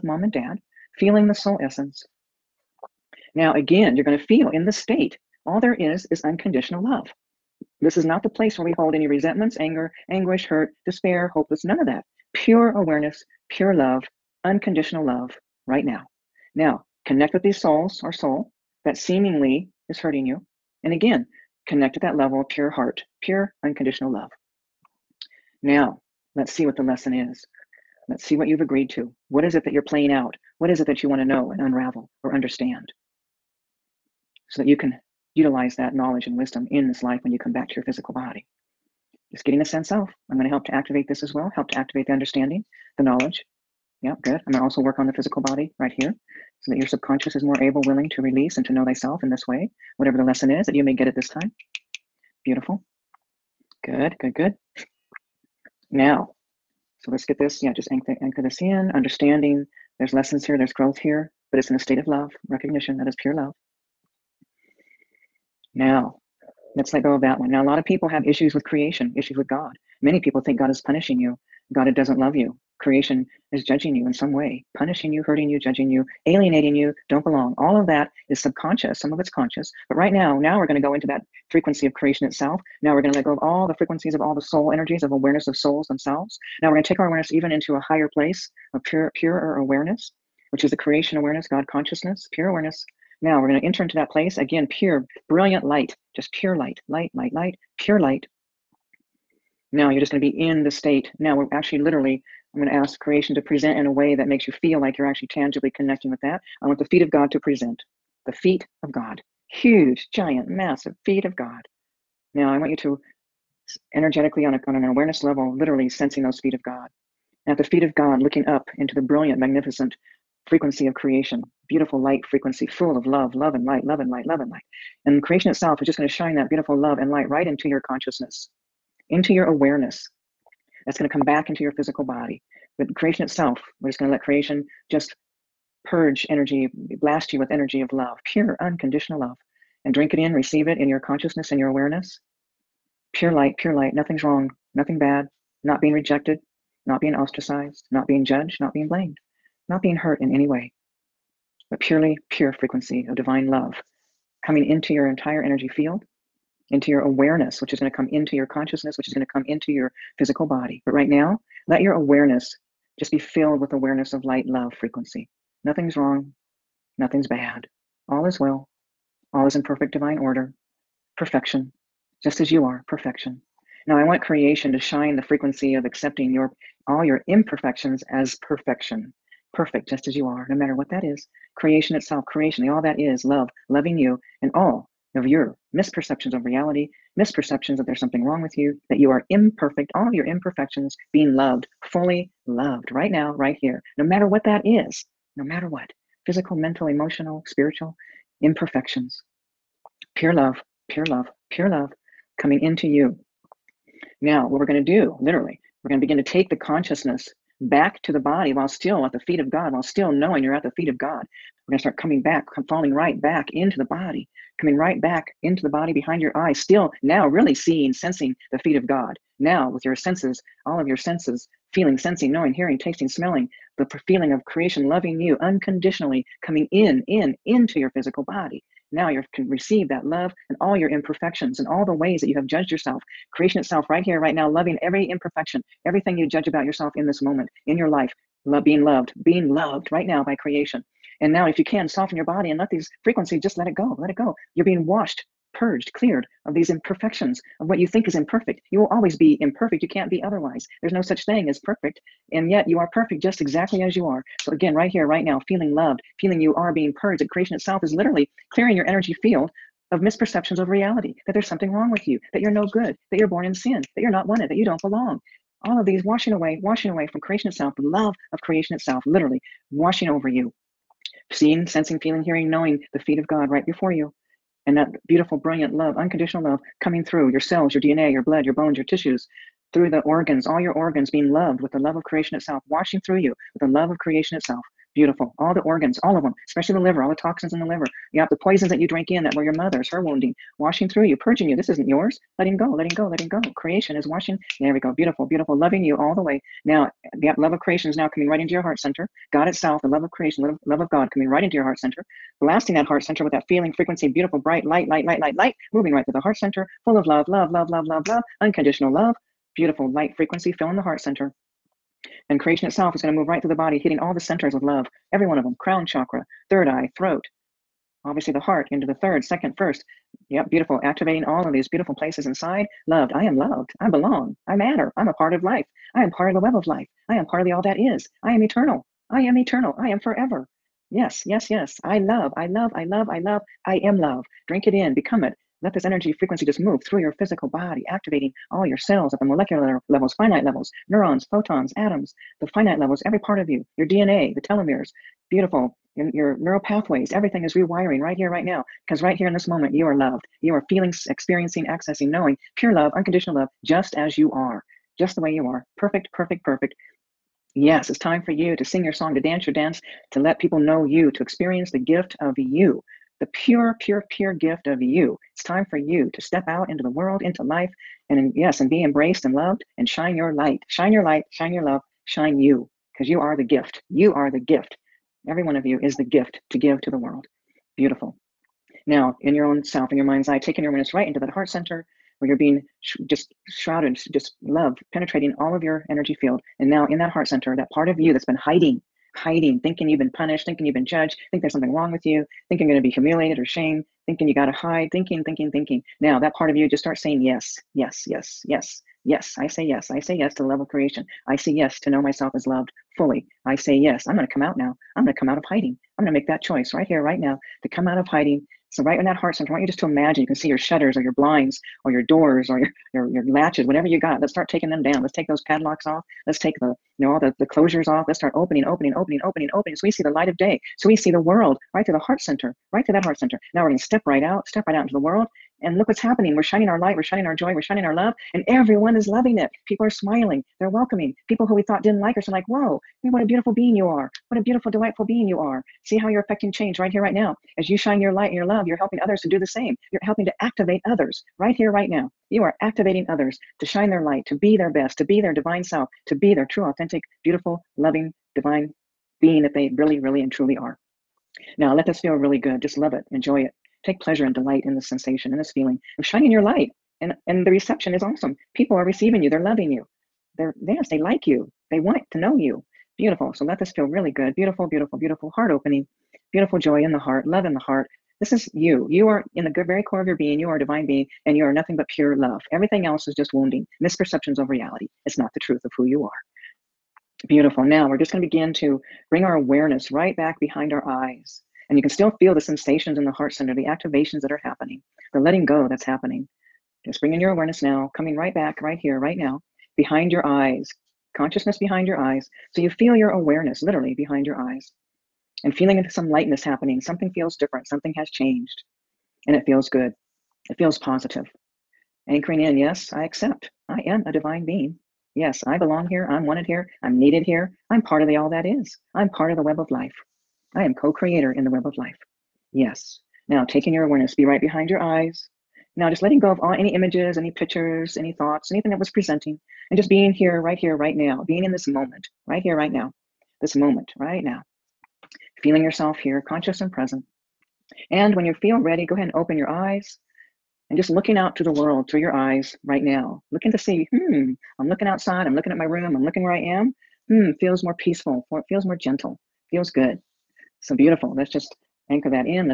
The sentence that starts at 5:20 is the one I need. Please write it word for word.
Activating all of these beautiful places inside.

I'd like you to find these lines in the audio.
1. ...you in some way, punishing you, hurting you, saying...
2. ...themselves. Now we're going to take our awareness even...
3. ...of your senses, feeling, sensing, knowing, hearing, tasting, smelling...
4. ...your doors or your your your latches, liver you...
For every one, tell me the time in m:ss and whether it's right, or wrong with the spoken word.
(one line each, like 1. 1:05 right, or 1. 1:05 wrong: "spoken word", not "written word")
1. 1:13 wrong: "judging", not "saying"
2. 1:25 right
3. 3:40 right
4. 6:51 wrong: "whatever", not "liver".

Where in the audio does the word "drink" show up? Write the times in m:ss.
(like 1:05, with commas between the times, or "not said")
2:19, 5:34.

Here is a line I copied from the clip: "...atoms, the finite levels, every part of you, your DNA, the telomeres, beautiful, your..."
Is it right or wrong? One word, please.
right.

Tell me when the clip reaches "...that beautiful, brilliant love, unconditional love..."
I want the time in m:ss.
4:34.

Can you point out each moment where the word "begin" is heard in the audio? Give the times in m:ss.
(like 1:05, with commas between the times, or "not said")
3:26, 7:58.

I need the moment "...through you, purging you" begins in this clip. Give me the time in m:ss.
4:50.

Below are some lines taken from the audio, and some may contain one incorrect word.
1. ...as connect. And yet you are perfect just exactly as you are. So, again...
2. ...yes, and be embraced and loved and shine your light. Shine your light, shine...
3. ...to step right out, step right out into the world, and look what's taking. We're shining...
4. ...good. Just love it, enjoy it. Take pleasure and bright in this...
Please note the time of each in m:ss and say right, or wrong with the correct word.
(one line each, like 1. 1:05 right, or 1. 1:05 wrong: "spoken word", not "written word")
1. 4:11 wrong: "perfect", not "connect"
2. 6:08 right
3. 7:03 wrong: "happening", not "taking"
4. 7:32 wrong: "delight", not "bright".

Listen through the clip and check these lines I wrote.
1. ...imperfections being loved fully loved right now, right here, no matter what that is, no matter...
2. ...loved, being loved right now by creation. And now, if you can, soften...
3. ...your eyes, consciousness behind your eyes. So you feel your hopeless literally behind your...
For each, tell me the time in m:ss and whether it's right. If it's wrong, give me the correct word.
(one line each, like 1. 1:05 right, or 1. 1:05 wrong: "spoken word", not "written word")
1. 3:10 right
2. 3:58 right
3. 8:10 wrong: "awareness", not "hopeless".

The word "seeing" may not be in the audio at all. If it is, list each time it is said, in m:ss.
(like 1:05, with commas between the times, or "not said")
3:37, 4:31.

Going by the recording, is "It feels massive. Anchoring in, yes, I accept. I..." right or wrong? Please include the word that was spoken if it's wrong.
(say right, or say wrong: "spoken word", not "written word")
wrong: "positive", not "massive".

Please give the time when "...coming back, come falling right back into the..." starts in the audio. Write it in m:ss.
3:31.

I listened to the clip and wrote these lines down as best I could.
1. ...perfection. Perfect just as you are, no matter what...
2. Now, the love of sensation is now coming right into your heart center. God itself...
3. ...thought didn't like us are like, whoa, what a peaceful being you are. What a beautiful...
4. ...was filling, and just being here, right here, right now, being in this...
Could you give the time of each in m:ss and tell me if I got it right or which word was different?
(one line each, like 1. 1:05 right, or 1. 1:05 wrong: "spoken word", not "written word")
1. 2:58 right
2. 4:56 wrong: "creation", not "sensation"
3. 7:11 wrong: "beautiful", not "peaceful"
4. 8:38 wrong: "presenting", not "filling".